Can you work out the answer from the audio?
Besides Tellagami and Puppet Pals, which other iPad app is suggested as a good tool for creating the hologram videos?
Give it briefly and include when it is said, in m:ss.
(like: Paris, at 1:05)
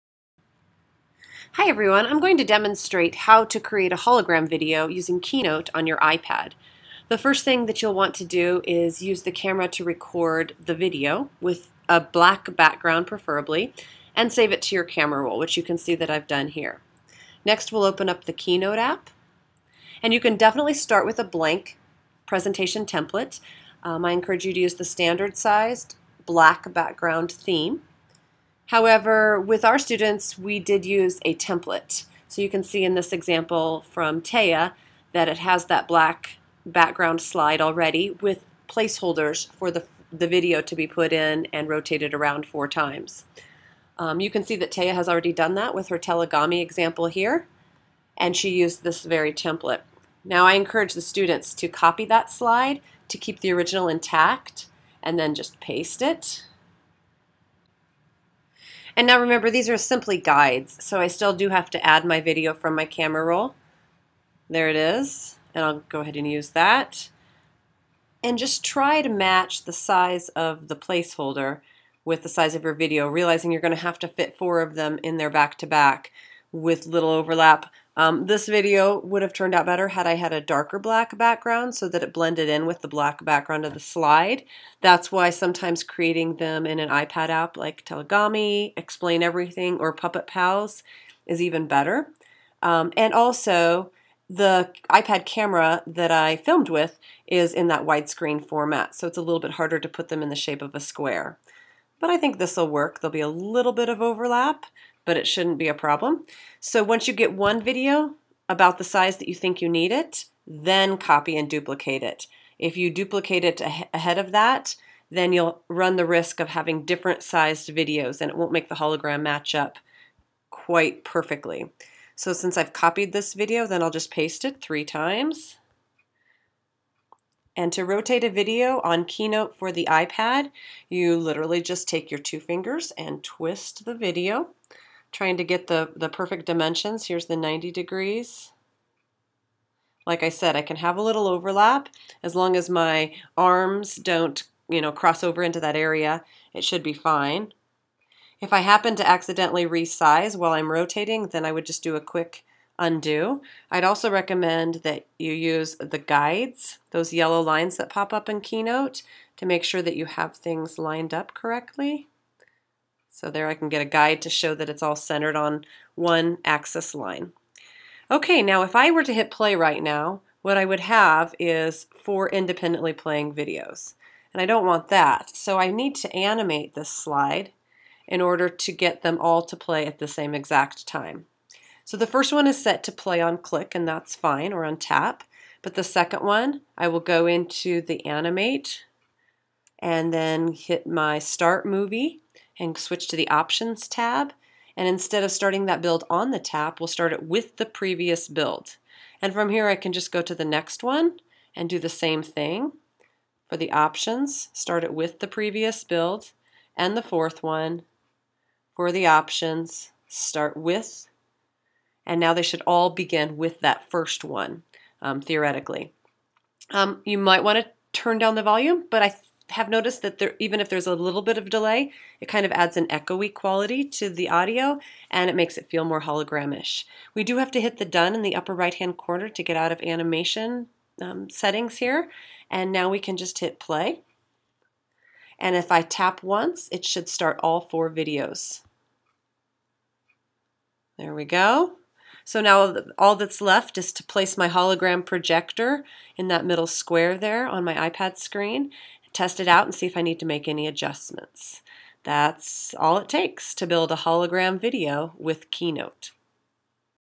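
Explain Everything, at 1:28.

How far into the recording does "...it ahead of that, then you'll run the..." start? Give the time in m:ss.
1:53.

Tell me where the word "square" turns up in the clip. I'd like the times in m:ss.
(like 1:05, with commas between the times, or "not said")
1:40, 4:06.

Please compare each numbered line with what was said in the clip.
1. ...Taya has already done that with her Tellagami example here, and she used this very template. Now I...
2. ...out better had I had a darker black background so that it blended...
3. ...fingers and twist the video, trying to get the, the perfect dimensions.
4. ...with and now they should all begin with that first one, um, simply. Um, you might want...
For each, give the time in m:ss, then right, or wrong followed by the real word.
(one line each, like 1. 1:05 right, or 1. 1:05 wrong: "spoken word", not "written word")
1. 0:44 right
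2. 1:19 right
3. 2:12 right
4. 3:30 wrong: "theoretically", not "simply".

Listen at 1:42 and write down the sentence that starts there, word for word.
There'll be a little bit of overlap, but it shouldn't be a problem.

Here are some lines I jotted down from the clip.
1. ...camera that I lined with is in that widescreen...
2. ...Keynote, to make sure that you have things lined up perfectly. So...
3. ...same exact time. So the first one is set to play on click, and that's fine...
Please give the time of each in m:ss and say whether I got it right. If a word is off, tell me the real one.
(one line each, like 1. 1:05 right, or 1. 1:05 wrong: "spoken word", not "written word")
1. 1:35 wrong: "filmed", not "lined"
2. 2:38 wrong: "correctly", not "perfectly"
3. 3:00 right.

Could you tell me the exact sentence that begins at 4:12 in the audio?
That's all it takes to build a hologram video with Keynote.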